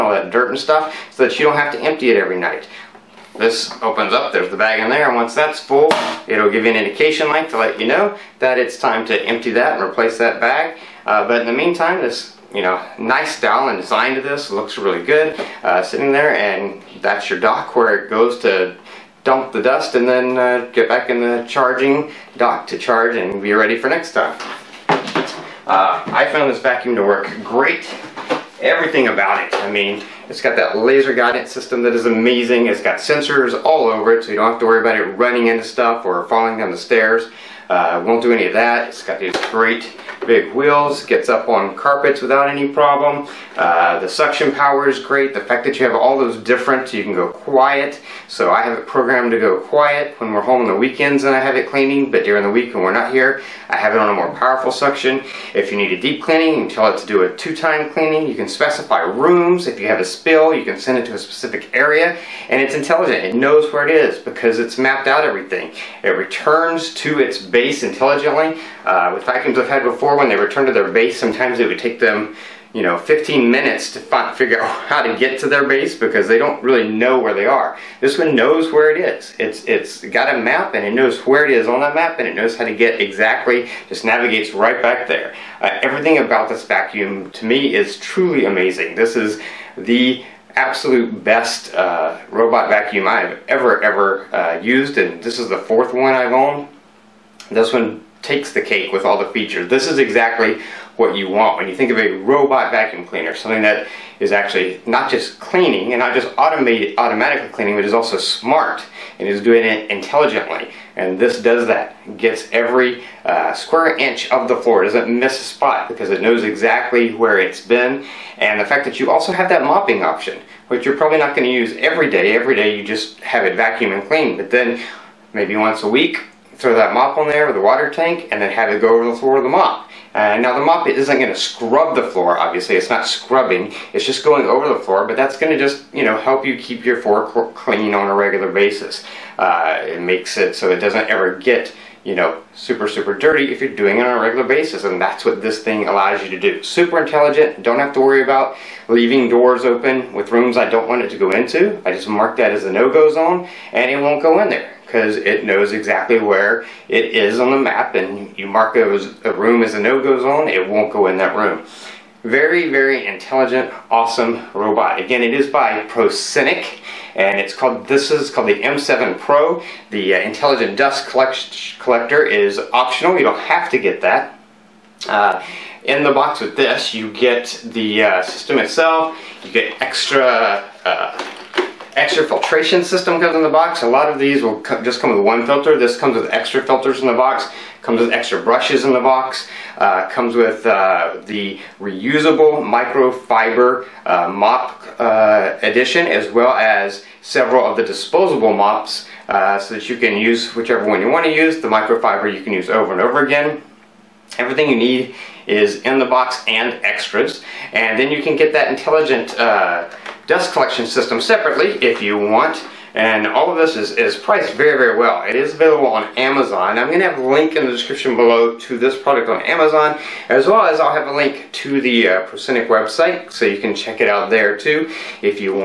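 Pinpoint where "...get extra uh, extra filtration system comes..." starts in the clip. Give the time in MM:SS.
02:59.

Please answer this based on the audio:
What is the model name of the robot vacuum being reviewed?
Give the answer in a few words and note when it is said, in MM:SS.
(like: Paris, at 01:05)
M7 Pro, at 02:48.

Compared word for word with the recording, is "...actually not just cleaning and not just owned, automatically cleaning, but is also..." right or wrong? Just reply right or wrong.
wrong.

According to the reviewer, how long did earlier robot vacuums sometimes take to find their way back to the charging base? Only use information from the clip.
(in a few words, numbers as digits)
15 minutes.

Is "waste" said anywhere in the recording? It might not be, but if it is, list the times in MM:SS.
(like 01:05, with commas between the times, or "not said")
not said.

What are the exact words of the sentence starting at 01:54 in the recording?
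doesn't miss a spot because it knows exactly where it's been.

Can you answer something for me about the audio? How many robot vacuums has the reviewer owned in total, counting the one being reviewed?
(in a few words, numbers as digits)
4.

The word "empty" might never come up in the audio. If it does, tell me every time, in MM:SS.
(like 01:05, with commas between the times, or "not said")
00:01, 00:09.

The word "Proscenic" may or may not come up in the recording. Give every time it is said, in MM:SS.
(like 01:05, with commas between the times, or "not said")
02:45, 03:42.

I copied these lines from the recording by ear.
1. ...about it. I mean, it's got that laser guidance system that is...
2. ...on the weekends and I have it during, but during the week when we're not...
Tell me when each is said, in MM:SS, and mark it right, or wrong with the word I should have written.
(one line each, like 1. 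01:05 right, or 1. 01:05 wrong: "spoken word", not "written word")
1. 00:29 right
2. 00:50 wrong: "cleaning", not "during".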